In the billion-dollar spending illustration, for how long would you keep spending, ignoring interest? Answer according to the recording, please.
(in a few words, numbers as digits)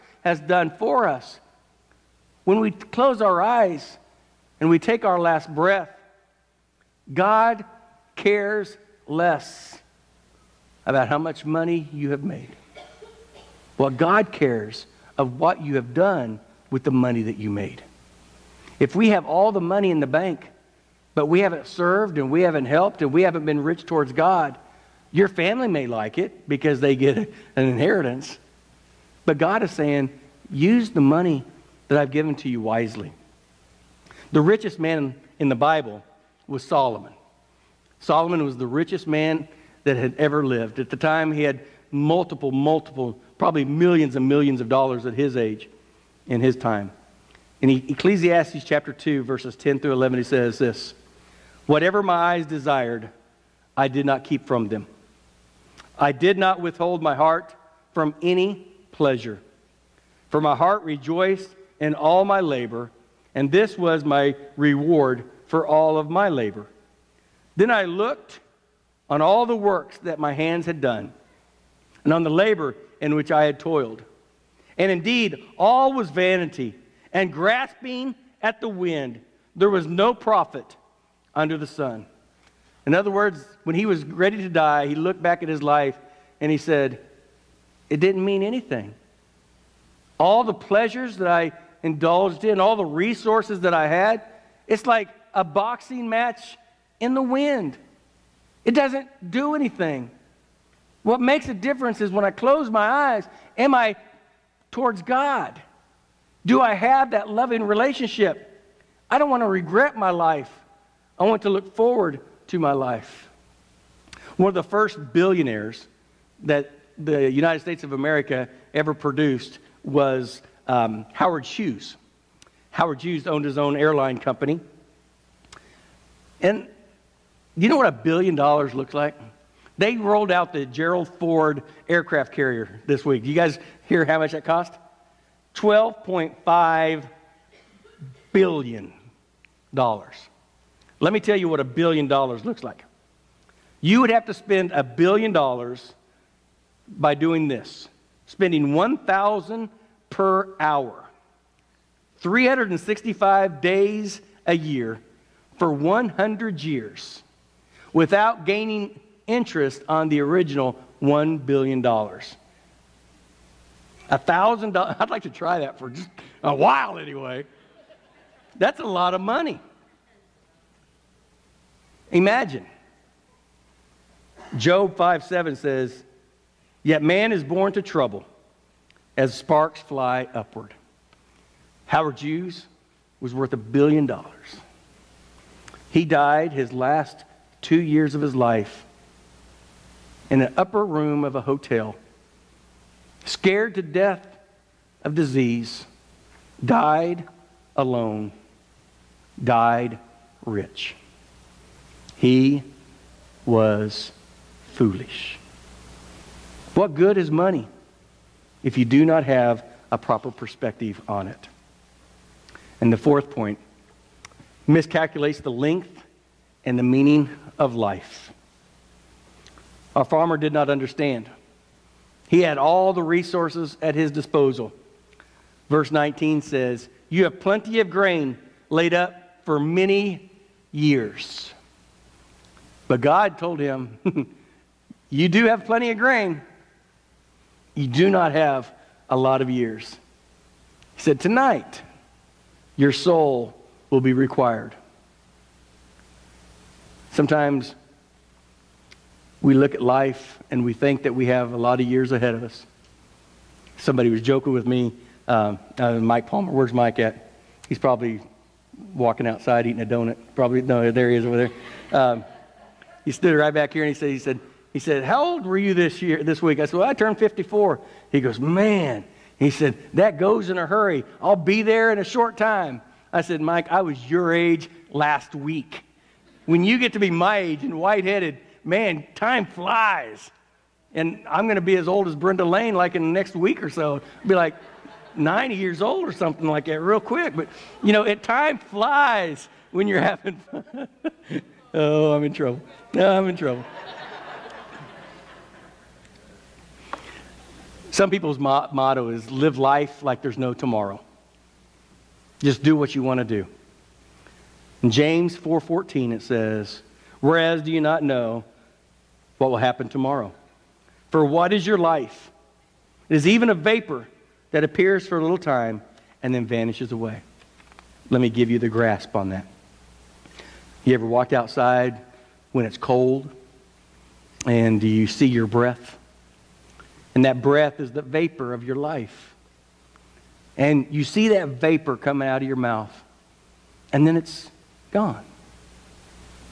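100 years.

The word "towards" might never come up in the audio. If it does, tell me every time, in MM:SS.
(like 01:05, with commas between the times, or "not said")
00:23, 01:44.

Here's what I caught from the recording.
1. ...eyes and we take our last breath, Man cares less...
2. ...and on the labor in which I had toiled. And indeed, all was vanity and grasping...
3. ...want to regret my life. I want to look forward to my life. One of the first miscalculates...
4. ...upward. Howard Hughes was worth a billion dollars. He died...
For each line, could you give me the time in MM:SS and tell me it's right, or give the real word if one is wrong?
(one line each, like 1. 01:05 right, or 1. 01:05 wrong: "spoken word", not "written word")
1. 00:03 wrong: "God", not "Man"
2. 01:12 right
3. 01:49 wrong: "billionaires", not "miscalculates"
4. 03:00 right.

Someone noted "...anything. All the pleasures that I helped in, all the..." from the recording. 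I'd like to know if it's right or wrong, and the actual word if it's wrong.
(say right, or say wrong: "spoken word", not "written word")
wrong: "indulged", not "helped".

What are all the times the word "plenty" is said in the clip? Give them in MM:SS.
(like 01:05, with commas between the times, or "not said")
03:47, 03:55.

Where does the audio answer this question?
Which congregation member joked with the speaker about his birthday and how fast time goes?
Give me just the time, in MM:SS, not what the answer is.
04:15.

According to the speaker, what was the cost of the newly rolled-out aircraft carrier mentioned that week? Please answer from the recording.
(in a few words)
$12.5 billion.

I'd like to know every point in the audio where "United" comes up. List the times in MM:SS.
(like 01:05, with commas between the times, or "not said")
01:57.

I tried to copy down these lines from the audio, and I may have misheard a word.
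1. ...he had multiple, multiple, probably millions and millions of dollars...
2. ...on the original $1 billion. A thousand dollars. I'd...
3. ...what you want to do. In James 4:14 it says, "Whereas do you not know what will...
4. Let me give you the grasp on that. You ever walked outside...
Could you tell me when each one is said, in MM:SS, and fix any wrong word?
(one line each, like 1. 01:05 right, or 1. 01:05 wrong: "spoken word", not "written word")
1. 00:41 right
2. 02:39 right
3. 05:02 right
4. 05:18 right.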